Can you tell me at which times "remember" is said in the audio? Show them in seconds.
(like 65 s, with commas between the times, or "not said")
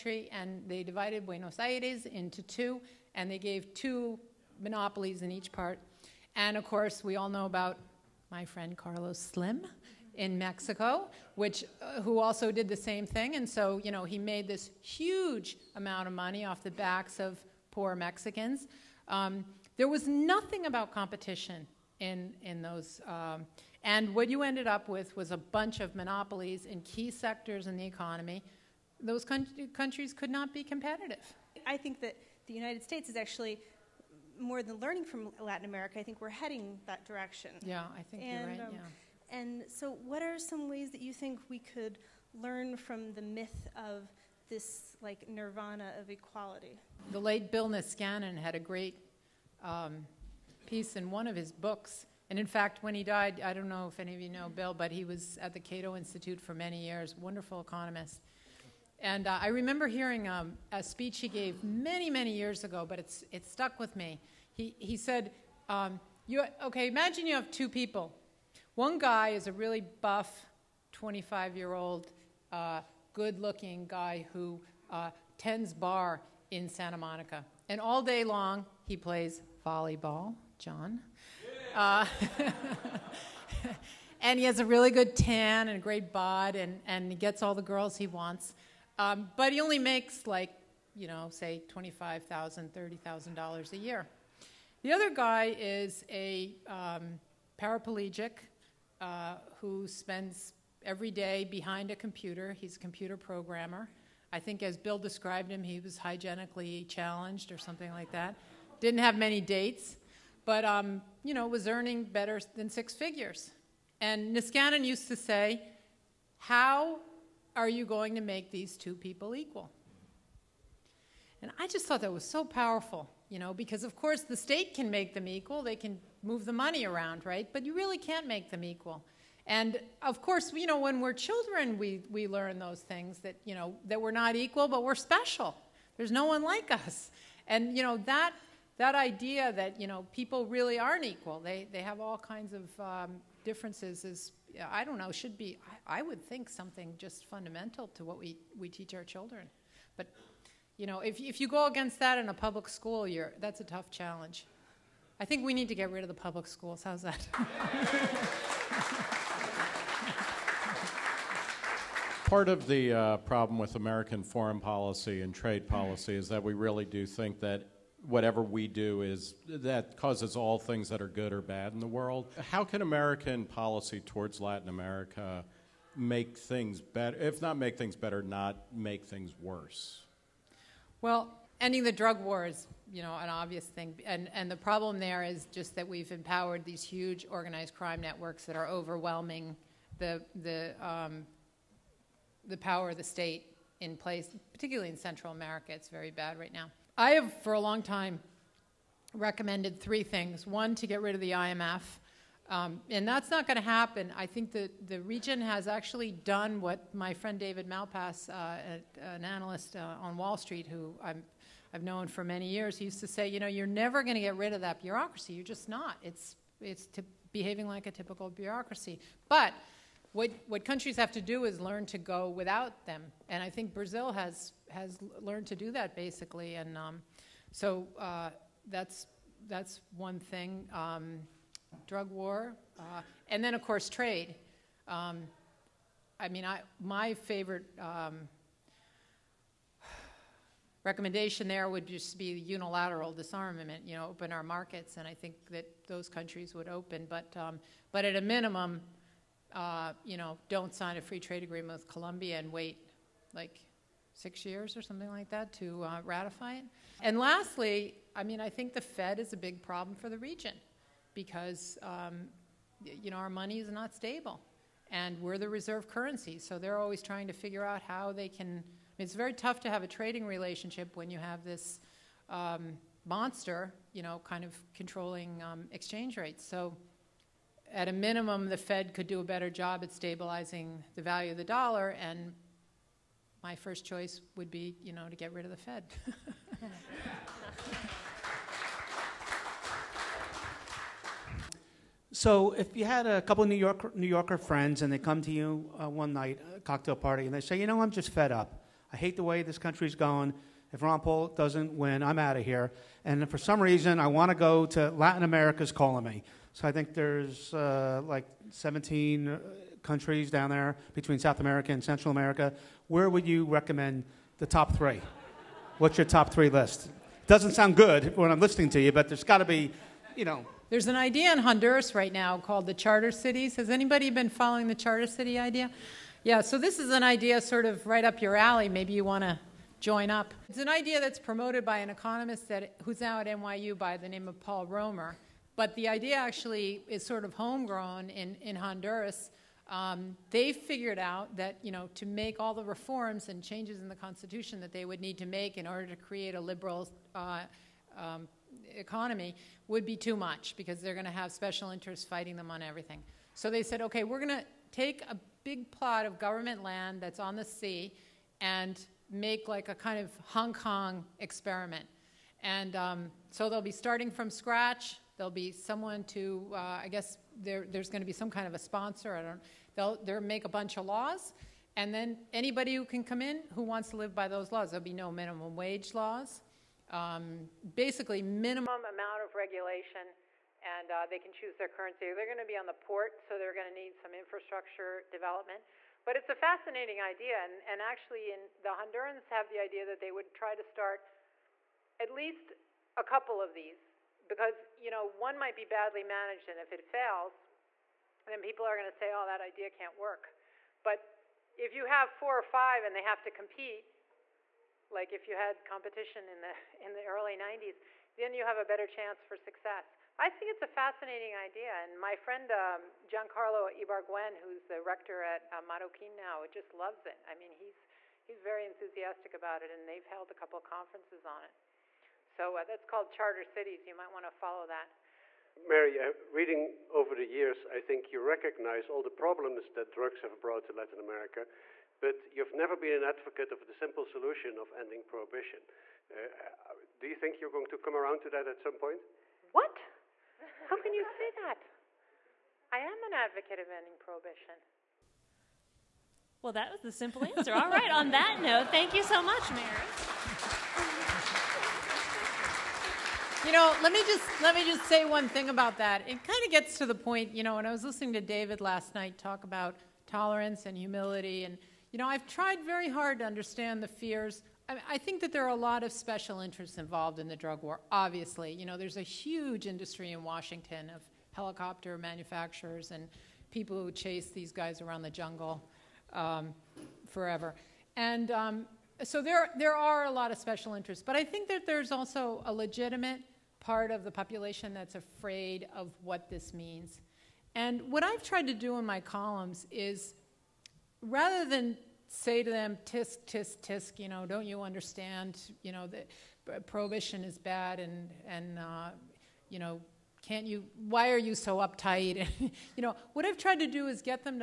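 59 s.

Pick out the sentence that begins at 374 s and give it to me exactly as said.
There'll be no minimum wage laws.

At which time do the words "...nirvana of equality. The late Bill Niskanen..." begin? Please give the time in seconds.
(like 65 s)
45 s.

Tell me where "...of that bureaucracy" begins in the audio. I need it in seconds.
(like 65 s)
214 s.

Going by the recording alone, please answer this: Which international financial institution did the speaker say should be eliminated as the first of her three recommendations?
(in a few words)
IMF.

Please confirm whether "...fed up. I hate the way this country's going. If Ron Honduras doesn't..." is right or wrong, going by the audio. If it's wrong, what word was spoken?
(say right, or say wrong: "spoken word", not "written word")
wrong: "Paul", not "Honduras".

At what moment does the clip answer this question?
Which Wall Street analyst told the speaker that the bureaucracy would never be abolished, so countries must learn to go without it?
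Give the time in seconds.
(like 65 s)
207 s.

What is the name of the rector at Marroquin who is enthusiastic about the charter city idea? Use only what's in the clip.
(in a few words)
Giancarlo Ibarguen.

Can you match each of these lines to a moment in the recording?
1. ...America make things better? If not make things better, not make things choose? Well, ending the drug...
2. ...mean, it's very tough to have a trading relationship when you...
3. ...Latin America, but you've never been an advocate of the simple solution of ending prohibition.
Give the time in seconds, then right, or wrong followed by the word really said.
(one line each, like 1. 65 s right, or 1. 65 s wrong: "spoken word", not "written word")
1. 174 s wrong: "worse", not "choose"
2. 268 s right
3. 430 s right.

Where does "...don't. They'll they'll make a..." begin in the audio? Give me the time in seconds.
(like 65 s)
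369 s.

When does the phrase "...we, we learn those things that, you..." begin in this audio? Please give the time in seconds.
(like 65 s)
131 s.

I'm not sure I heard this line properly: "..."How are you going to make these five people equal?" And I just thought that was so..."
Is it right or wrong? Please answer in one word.
wrong.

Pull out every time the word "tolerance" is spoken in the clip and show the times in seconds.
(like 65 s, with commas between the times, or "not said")
460 s.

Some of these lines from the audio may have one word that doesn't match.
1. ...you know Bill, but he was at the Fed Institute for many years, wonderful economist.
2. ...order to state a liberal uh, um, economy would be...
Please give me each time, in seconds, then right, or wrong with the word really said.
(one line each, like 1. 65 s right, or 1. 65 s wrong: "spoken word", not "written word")
1. 54 s wrong: "Cato", not "Fed"
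2. 345 s wrong: "create", not "state".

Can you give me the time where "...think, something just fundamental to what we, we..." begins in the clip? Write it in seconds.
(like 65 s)
146 s.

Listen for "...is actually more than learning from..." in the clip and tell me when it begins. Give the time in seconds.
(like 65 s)
33 s.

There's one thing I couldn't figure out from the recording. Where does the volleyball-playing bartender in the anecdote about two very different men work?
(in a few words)
Santa Monica.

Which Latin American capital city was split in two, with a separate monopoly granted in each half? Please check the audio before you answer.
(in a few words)
Buenos Aires.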